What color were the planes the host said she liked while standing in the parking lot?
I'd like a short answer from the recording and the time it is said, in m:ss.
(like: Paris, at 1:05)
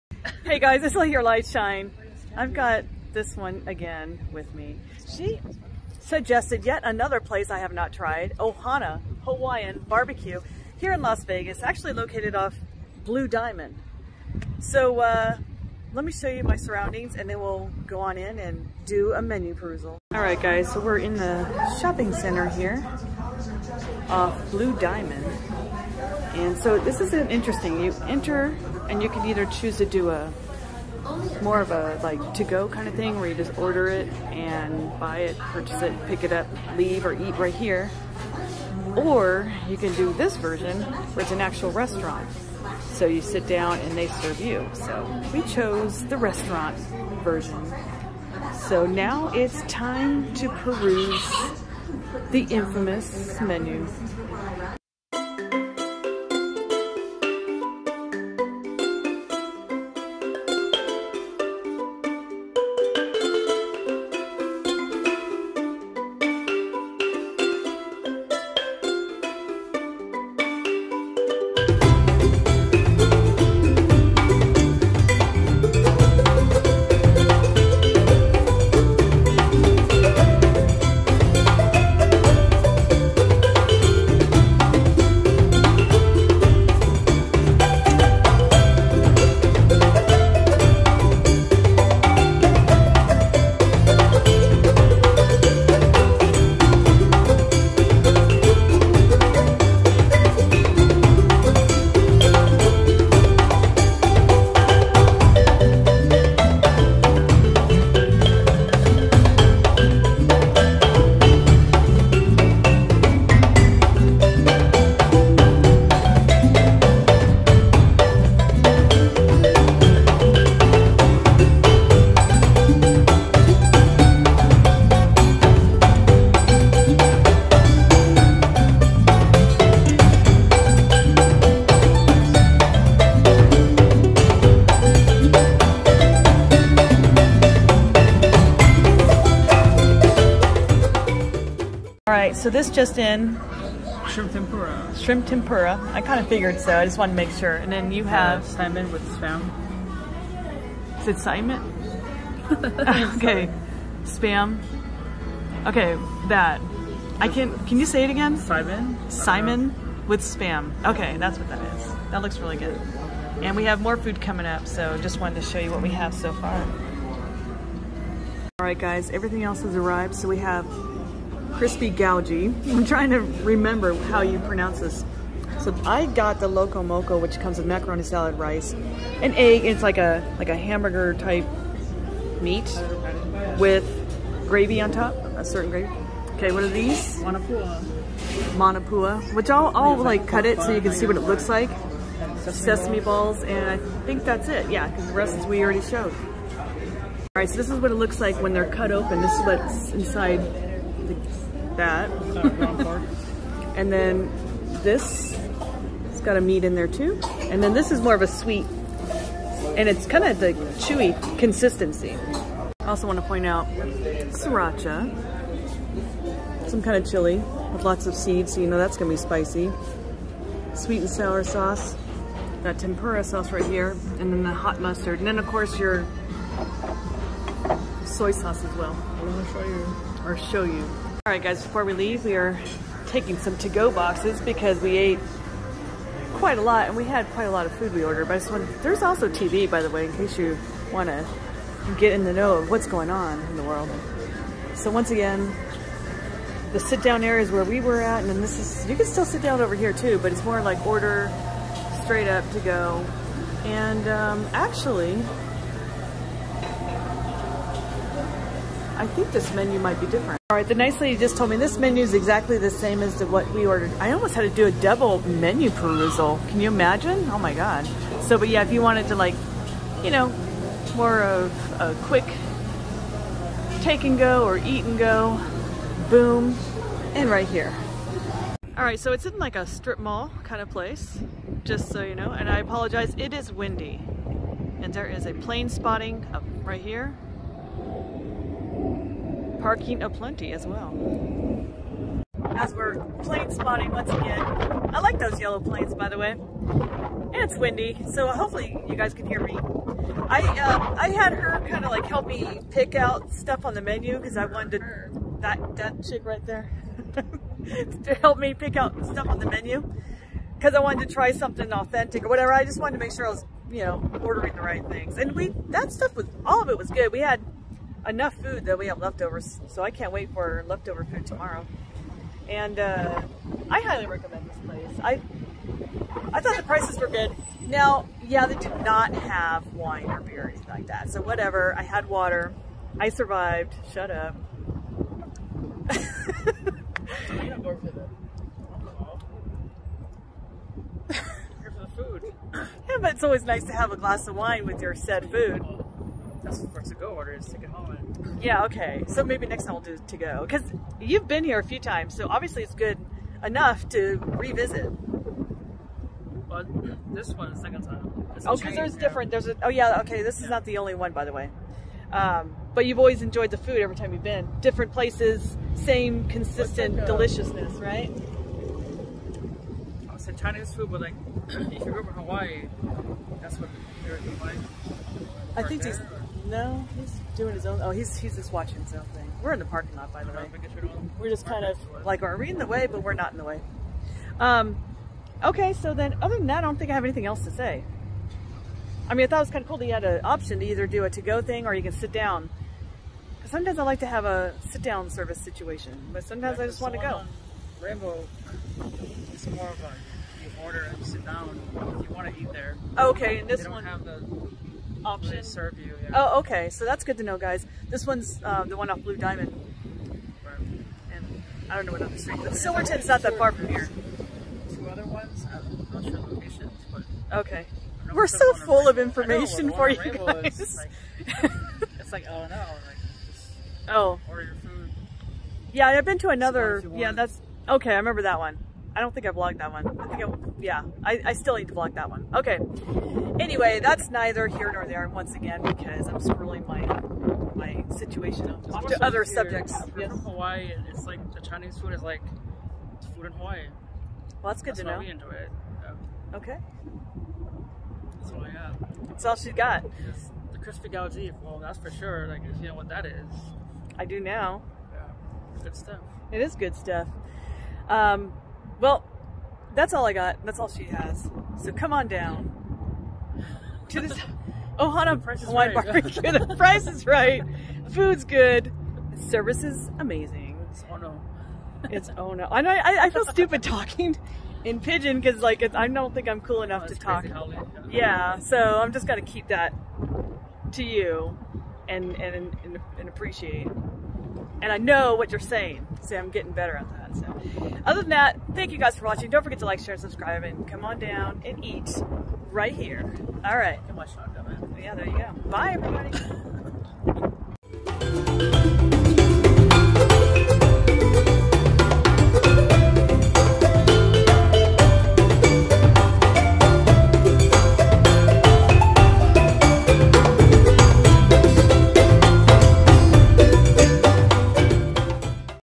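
Yellow, at 4:55.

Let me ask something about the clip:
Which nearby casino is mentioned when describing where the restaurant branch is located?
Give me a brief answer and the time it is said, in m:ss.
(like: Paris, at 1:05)
Silverton, at 6:52.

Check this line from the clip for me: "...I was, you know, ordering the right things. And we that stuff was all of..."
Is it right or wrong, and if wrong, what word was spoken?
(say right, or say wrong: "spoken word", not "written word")
right.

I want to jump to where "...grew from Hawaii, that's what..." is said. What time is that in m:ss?
6:11.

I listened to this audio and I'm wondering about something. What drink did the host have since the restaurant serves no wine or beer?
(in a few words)
Water.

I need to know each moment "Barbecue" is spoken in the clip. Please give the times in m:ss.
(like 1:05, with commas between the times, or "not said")
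0:09, 7:45.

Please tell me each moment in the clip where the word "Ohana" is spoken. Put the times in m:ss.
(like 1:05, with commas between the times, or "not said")
0:08, 7:44.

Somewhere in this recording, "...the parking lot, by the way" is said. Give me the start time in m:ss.
6:19.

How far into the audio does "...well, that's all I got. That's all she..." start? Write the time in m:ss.
7:38.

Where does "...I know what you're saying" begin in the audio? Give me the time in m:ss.
8:04.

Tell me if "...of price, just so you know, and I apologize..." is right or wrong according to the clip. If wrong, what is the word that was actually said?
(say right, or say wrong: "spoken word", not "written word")
wrong: "place", not "price".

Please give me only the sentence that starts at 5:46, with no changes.
That's for to-go order is take it home.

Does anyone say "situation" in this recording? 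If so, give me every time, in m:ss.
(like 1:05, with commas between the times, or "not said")
6:35, 7:17.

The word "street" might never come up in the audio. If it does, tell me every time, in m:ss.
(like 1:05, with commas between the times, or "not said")
6:52.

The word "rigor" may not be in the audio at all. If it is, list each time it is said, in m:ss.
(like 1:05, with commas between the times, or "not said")
not said.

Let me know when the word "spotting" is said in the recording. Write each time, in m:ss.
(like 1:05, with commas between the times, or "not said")
4:45, 4:53.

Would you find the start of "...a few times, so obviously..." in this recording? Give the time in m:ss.
5:51.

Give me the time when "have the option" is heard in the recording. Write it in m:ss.
6:43.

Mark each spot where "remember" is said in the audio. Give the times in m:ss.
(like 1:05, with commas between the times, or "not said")
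2:53, 7:07.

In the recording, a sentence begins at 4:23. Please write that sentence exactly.
I almost had to do a double menu perusal.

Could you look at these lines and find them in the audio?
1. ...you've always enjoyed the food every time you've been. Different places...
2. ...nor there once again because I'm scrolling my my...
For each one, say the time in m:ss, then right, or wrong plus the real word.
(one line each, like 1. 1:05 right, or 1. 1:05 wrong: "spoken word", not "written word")
1. 6:02 right
2. 7:14 right.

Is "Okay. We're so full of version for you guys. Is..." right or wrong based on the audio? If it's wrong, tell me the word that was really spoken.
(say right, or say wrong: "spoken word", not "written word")
wrong: "information", not "version".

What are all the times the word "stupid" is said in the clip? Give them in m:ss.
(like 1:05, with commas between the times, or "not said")
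7:53.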